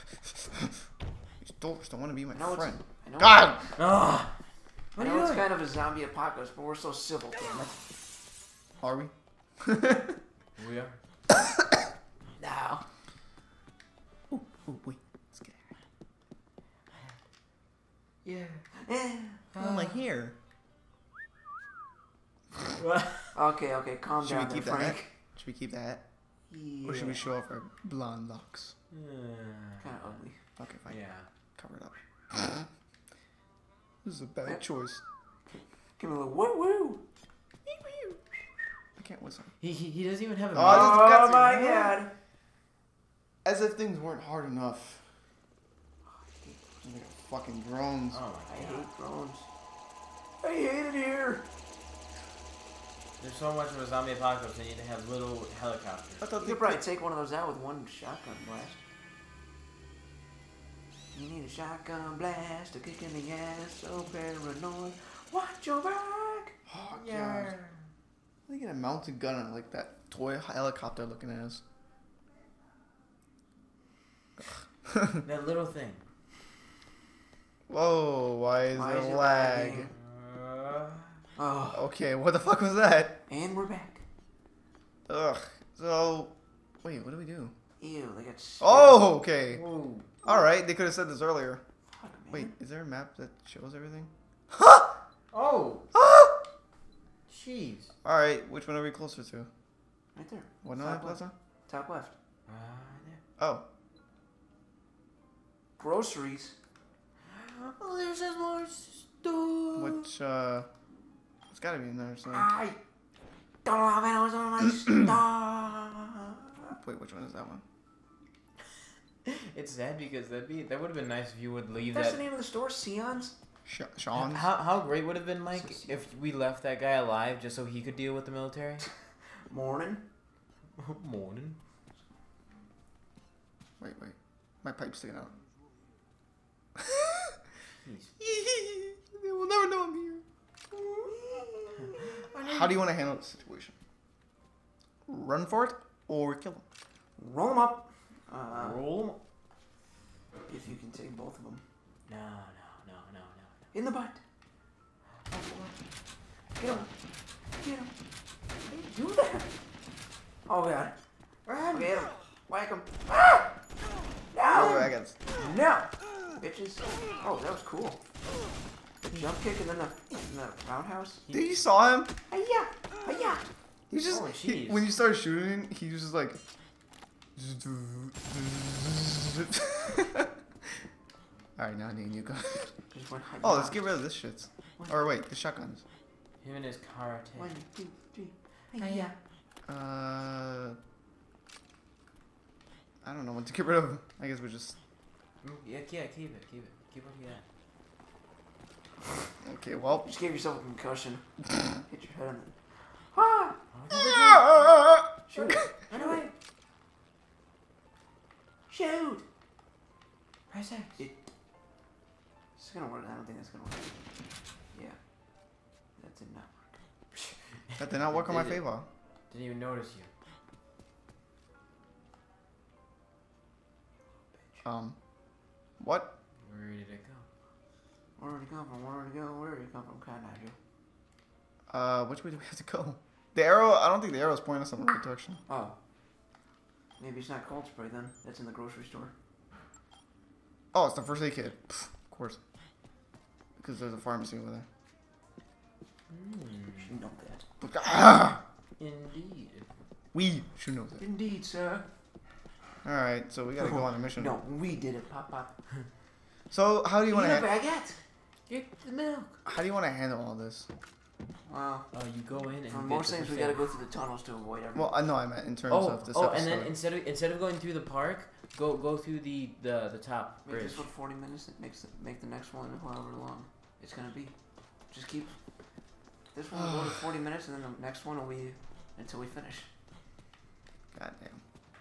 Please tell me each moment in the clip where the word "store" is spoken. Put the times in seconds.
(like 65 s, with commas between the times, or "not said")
122 s, 238 s.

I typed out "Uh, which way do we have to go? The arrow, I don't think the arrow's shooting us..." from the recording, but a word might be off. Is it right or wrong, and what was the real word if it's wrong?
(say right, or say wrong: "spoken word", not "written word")
wrong: "pointing", not "shooting".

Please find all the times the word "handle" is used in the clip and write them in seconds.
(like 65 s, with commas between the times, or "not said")
142 s, 259 s.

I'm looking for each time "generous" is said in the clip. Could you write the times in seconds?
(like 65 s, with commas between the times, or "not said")
not said.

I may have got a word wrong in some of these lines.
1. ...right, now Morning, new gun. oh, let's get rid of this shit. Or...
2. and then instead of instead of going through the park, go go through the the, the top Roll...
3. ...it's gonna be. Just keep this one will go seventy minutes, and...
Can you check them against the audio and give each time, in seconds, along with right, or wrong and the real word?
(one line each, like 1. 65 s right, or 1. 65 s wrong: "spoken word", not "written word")
1. 181 s wrong: "Dean", not "Morning"
2. 266 s wrong: "Make", not "Roll"
3. 273 s wrong: "forty", not "seventy".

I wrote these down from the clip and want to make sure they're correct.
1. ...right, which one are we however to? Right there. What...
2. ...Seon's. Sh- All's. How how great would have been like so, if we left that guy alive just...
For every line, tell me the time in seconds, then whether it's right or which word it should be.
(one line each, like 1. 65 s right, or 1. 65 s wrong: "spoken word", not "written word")
1. 98 s wrong: "closer", not "however"
2. 122 s wrong: "Seon", not "All".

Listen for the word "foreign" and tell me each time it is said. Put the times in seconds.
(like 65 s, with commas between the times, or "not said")
not said.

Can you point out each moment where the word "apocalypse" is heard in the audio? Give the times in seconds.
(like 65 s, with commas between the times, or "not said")
6 s, 54 s.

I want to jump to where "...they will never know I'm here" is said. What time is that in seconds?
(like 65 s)
139 s.